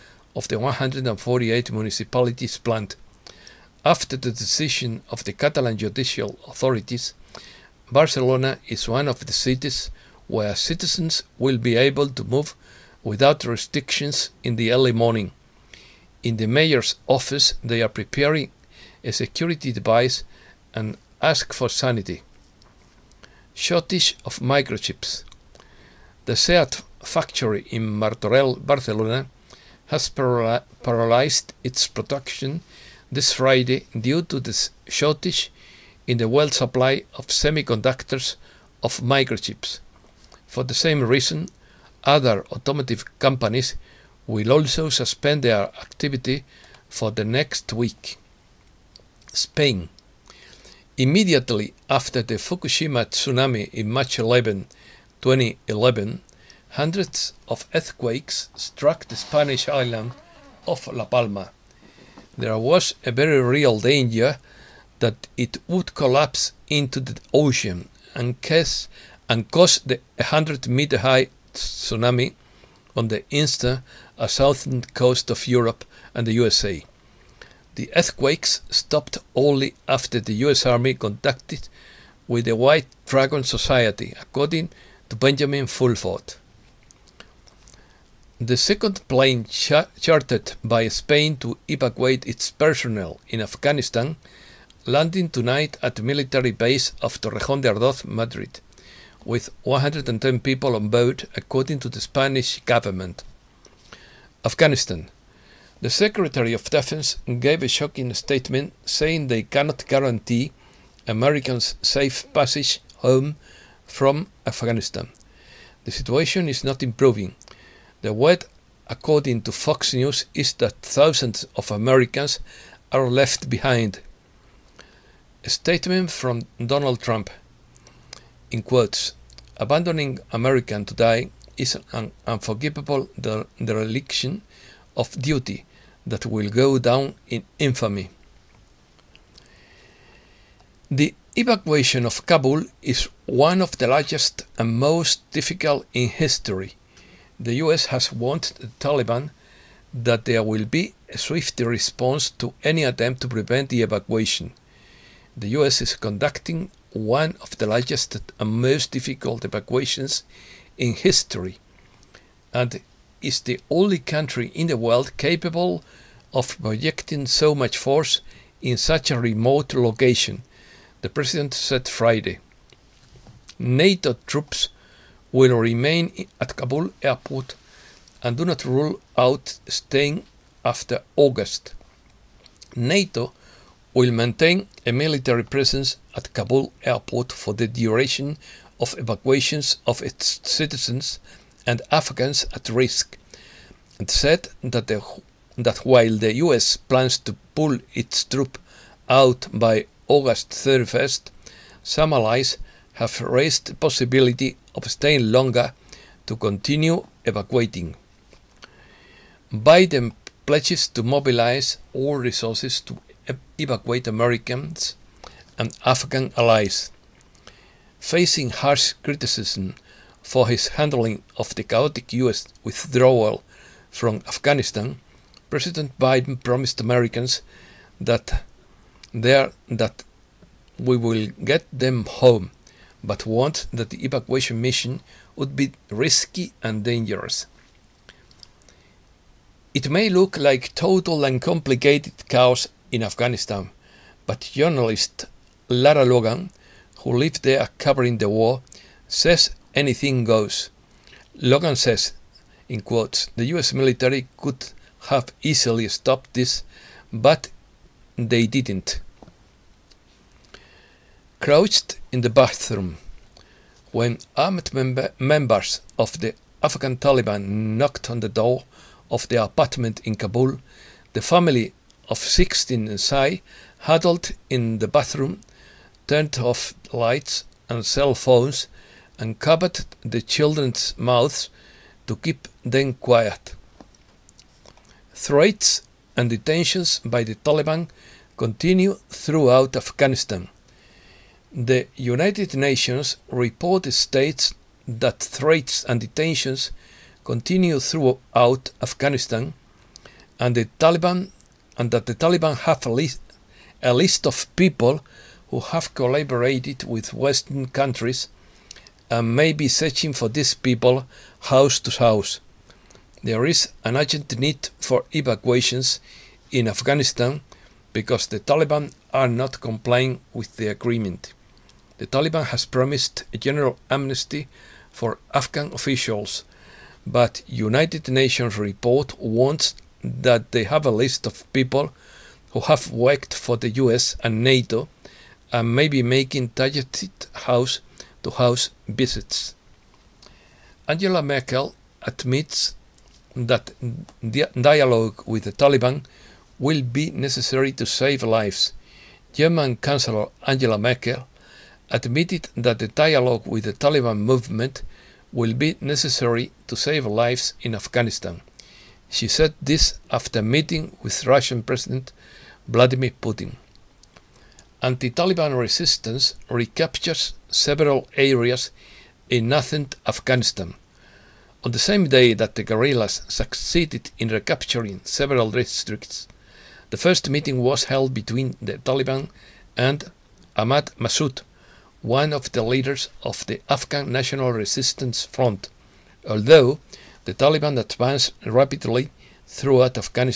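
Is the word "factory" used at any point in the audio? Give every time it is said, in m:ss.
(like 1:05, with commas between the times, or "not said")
0:27.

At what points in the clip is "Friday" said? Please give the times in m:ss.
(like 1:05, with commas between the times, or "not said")
0:33, 2:51.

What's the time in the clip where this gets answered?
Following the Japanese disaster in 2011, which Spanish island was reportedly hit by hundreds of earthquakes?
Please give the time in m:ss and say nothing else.
1:00.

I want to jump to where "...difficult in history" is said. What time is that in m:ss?
2:25.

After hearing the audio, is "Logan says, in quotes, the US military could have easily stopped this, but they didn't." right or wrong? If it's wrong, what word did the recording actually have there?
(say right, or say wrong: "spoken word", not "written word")
right.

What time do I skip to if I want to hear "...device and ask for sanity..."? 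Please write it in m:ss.
0:19.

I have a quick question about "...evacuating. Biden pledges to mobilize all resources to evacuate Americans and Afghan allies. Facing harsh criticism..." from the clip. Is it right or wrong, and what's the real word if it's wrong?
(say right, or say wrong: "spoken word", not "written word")
right.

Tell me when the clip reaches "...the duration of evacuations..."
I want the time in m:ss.
3:07.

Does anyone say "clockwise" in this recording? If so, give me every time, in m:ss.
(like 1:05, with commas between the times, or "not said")
not said.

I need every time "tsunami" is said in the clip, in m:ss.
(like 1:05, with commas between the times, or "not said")
0:53, 1:11.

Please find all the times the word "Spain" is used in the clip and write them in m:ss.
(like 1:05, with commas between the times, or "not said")
0:49, 1:30.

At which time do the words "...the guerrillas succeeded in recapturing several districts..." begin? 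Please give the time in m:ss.
6:12.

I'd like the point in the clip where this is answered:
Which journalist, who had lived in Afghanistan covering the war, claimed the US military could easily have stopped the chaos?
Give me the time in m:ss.
4:05.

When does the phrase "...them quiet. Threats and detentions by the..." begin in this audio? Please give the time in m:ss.
4:42.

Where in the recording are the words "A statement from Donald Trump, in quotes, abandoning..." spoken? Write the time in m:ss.
2:05.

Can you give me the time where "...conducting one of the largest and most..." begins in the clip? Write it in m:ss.
2:35.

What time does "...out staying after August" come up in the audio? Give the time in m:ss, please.
2:59.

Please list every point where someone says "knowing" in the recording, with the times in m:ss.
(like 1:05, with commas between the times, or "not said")
not said.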